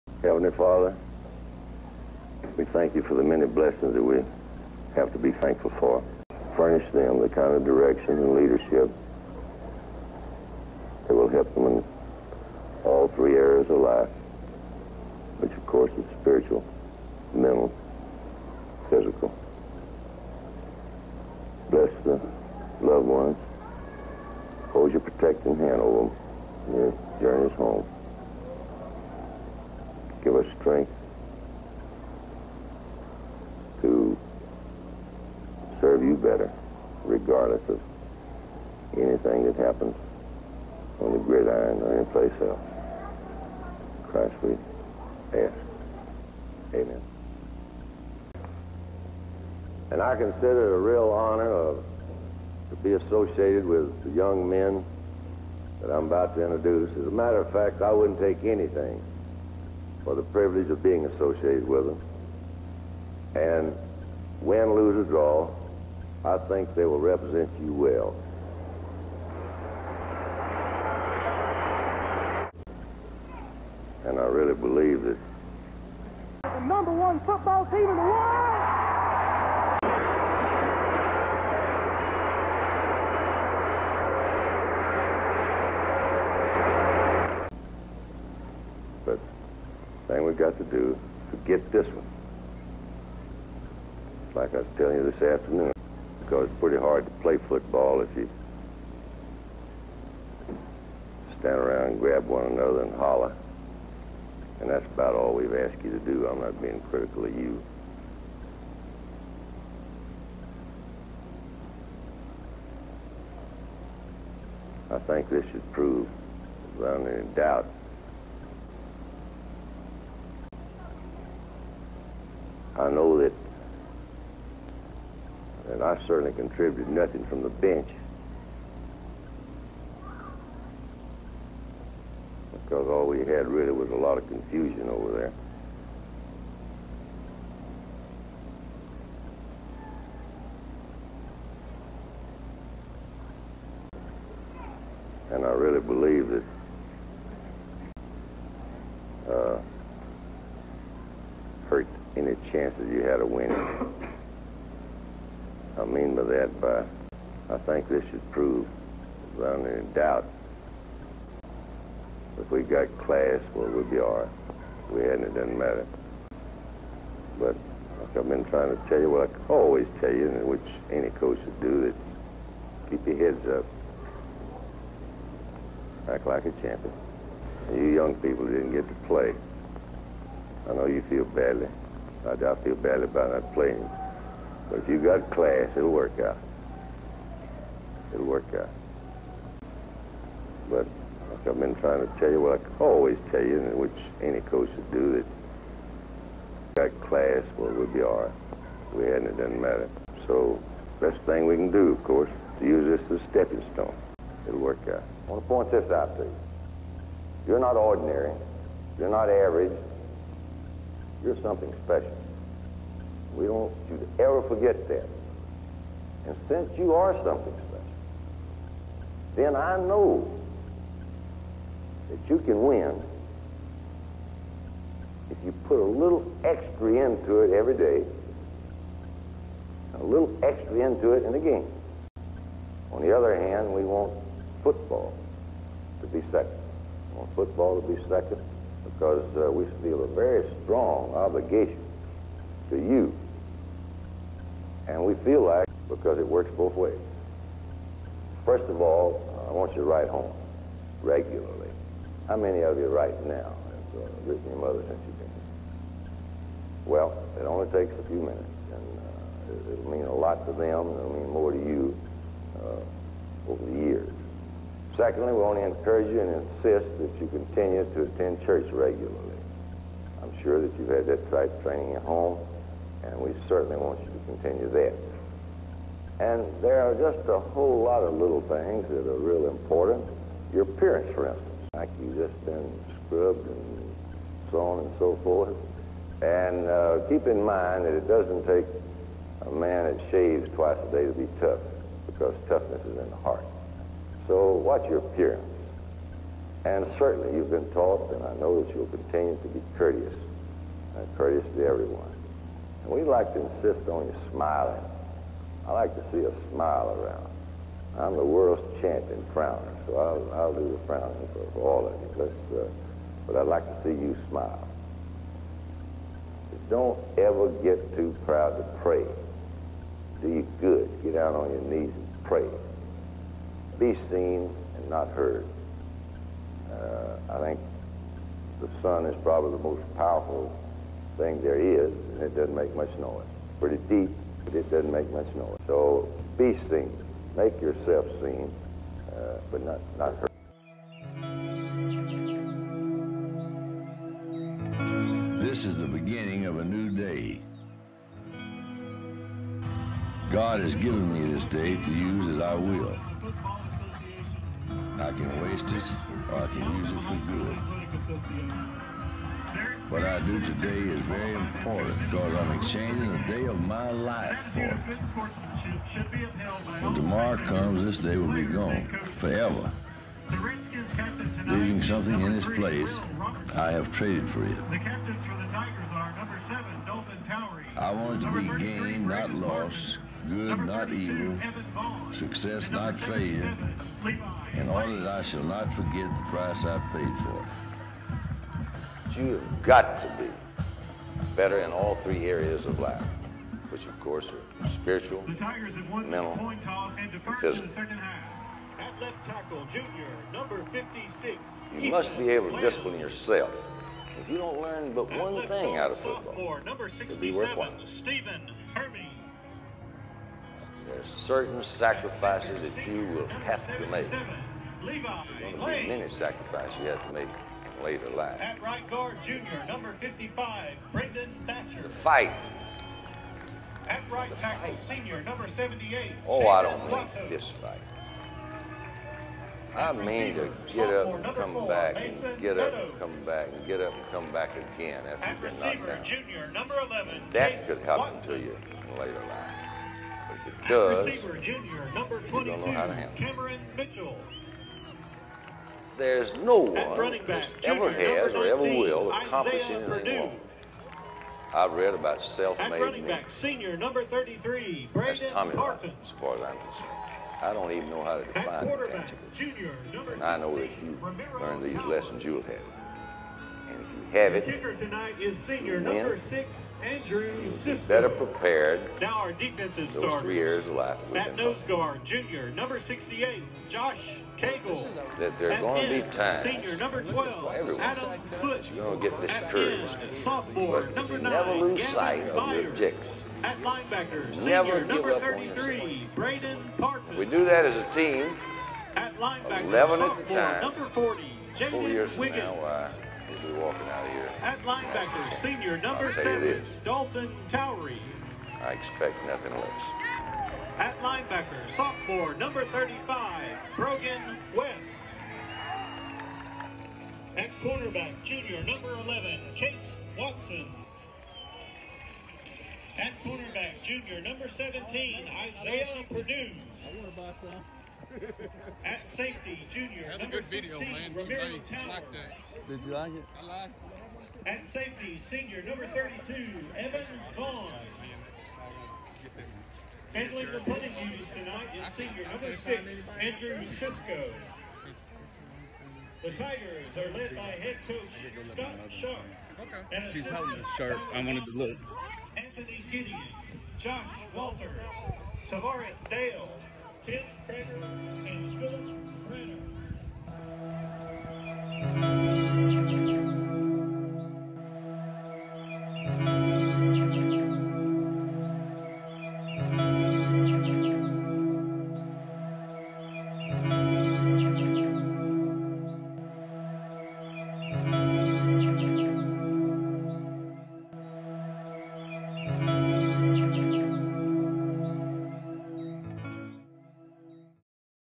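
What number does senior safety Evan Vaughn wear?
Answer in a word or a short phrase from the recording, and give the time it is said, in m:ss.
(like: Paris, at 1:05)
32, at 8:45.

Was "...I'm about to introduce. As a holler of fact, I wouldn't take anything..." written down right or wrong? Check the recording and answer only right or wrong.
wrong.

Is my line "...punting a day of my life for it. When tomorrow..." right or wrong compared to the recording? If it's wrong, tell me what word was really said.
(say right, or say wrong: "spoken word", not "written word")
wrong: "exchanging", not "punting".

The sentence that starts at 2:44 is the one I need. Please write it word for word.
If we hadn't, it doesn't matter.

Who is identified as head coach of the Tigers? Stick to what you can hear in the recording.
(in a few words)
Scott Sharp.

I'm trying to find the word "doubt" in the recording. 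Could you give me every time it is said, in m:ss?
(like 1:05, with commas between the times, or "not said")
1:57, 2:39, 3:02.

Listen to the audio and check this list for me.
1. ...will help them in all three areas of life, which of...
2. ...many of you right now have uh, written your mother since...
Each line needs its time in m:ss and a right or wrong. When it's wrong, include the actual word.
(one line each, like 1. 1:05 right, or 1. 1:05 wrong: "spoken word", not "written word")
1. 0:11 right
2. 4:12 right.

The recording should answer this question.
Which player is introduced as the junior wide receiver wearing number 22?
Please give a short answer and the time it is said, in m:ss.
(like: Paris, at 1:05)
Cameron Mitchell, at 7:23.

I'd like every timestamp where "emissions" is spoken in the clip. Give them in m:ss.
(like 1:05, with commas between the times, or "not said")
not said.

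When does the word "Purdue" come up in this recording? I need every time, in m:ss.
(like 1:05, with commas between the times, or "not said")
7:29, 8:36.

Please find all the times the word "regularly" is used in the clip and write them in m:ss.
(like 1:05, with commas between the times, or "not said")
4:11, 4:28.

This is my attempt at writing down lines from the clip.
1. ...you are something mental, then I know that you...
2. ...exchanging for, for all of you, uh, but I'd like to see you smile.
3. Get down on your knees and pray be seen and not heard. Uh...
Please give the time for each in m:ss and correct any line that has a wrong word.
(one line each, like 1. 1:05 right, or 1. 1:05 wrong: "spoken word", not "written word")
1. 3:36 wrong: "special", not "mental"
2. 5:10 wrong: "frowning", not "exchanging"
3. 5:21 right.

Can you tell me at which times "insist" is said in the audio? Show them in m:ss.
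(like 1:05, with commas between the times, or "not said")
4:26, 5:03.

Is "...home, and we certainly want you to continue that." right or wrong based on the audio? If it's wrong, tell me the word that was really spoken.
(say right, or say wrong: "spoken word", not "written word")
right.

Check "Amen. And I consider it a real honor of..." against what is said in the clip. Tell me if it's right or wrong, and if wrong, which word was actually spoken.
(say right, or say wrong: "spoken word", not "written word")
right.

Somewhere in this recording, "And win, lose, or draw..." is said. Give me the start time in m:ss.
1:03.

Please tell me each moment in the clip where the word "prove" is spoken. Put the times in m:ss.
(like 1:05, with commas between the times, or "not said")
1:55, 2:38.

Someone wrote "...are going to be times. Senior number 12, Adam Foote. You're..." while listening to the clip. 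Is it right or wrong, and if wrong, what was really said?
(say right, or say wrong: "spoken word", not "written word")
right.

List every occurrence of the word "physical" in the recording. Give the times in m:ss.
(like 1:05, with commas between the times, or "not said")
0:18, 6:37.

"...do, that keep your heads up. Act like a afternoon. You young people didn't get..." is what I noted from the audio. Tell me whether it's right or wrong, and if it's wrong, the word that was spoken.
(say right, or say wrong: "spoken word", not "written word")
wrong: "champion", not "afternoon".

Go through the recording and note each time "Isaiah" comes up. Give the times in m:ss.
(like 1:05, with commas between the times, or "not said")
7:29, 8:35.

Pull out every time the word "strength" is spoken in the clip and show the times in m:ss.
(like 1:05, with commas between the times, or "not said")
0:30.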